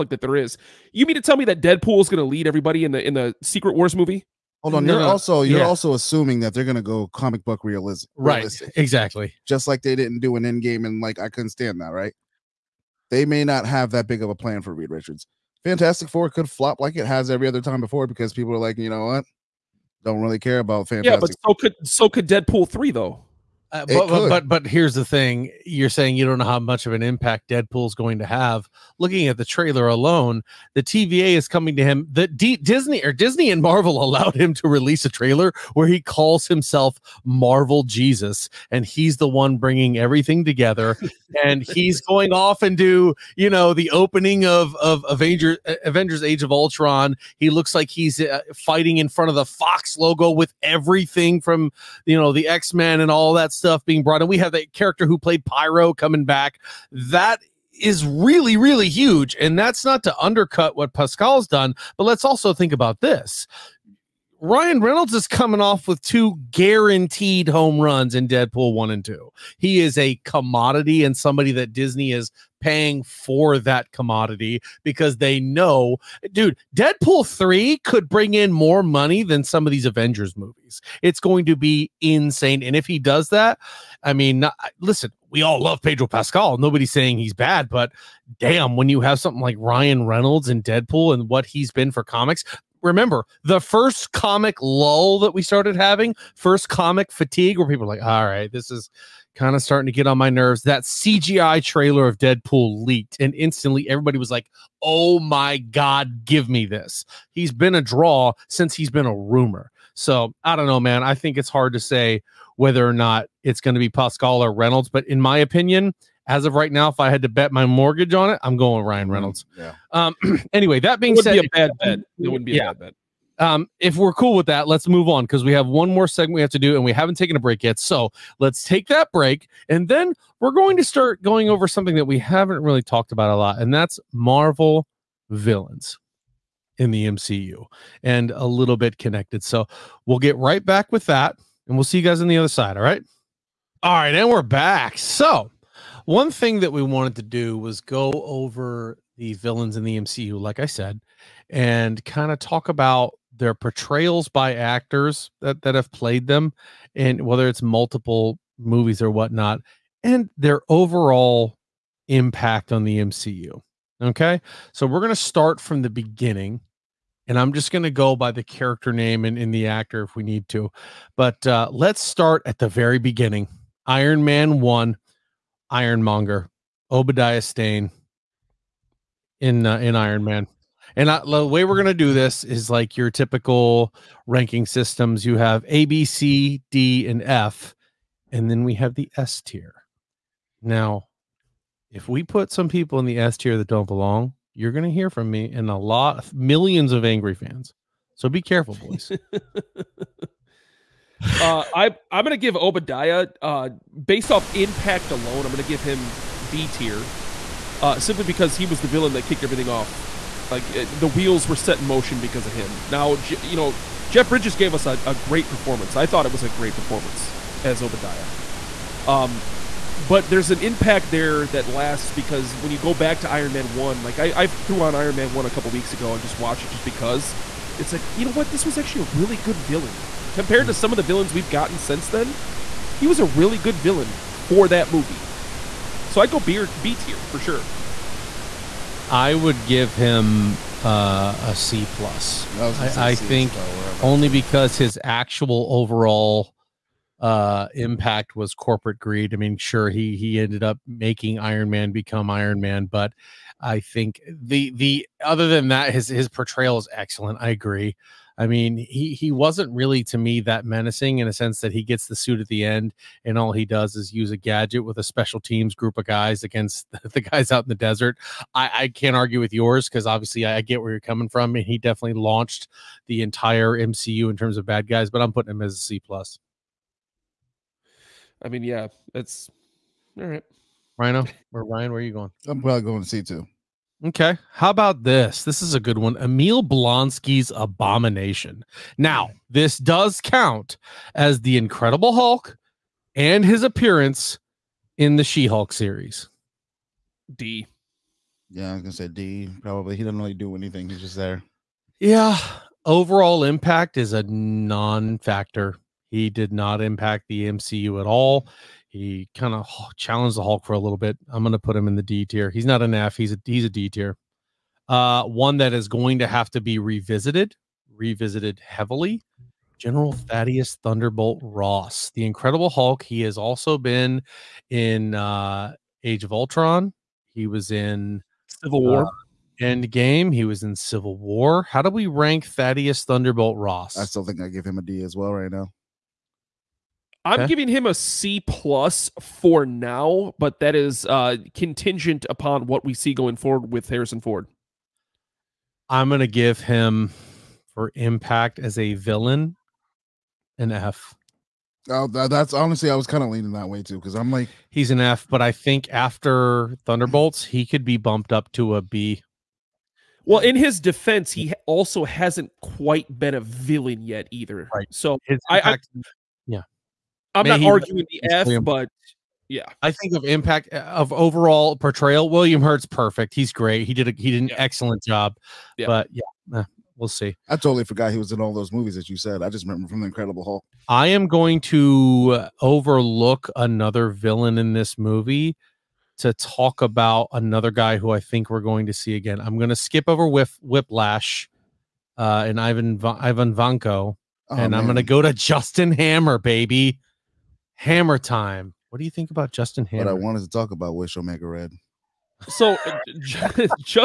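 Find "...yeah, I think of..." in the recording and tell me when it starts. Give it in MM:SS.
06:09.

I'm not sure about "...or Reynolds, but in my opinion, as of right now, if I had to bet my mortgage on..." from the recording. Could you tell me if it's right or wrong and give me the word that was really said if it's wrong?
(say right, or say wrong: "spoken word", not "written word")
right.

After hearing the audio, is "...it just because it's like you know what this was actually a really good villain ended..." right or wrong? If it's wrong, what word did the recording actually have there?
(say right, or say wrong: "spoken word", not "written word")
wrong: "compared", not "ended".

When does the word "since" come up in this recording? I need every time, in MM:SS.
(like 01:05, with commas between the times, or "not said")
01:48, 03:51.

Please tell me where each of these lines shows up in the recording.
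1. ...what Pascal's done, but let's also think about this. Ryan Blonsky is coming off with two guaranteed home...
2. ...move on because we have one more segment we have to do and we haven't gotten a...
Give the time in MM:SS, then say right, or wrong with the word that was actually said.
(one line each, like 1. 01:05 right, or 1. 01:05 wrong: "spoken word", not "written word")
1. 01:00 wrong: "Reynolds", not "Blonsky"
2. 02:04 wrong: "taken", not "gotten".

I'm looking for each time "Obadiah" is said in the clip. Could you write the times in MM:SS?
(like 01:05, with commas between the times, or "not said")
02:56, 03:22, 03:37.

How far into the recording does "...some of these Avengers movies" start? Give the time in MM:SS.
01:19.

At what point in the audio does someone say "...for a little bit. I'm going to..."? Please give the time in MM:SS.
05:10.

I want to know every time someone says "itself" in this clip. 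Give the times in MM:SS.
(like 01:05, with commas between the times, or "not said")
not said.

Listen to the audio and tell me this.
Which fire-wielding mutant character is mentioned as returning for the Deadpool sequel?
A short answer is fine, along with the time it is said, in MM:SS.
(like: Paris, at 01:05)
Pyro, at 00:55.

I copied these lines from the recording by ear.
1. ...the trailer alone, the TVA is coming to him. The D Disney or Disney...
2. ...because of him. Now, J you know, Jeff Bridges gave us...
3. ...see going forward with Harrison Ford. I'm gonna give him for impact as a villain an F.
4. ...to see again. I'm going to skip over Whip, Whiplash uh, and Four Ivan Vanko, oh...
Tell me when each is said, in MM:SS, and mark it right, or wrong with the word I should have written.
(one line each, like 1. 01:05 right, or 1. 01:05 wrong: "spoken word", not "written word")
1. 00:29 right
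2. 03:32 right
3. 05:42 right
4. 06:28 wrong: "Ivan", not "Four".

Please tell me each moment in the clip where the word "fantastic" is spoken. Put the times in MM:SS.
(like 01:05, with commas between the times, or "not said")
00:15, 00:20.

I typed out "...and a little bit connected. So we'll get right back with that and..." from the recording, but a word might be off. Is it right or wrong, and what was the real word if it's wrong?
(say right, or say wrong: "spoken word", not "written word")
right.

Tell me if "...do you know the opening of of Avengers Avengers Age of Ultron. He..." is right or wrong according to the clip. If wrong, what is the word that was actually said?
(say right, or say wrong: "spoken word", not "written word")
right.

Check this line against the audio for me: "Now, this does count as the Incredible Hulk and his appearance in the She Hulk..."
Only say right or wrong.
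right.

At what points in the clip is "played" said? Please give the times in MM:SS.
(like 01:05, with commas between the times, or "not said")
00:55, 02:35.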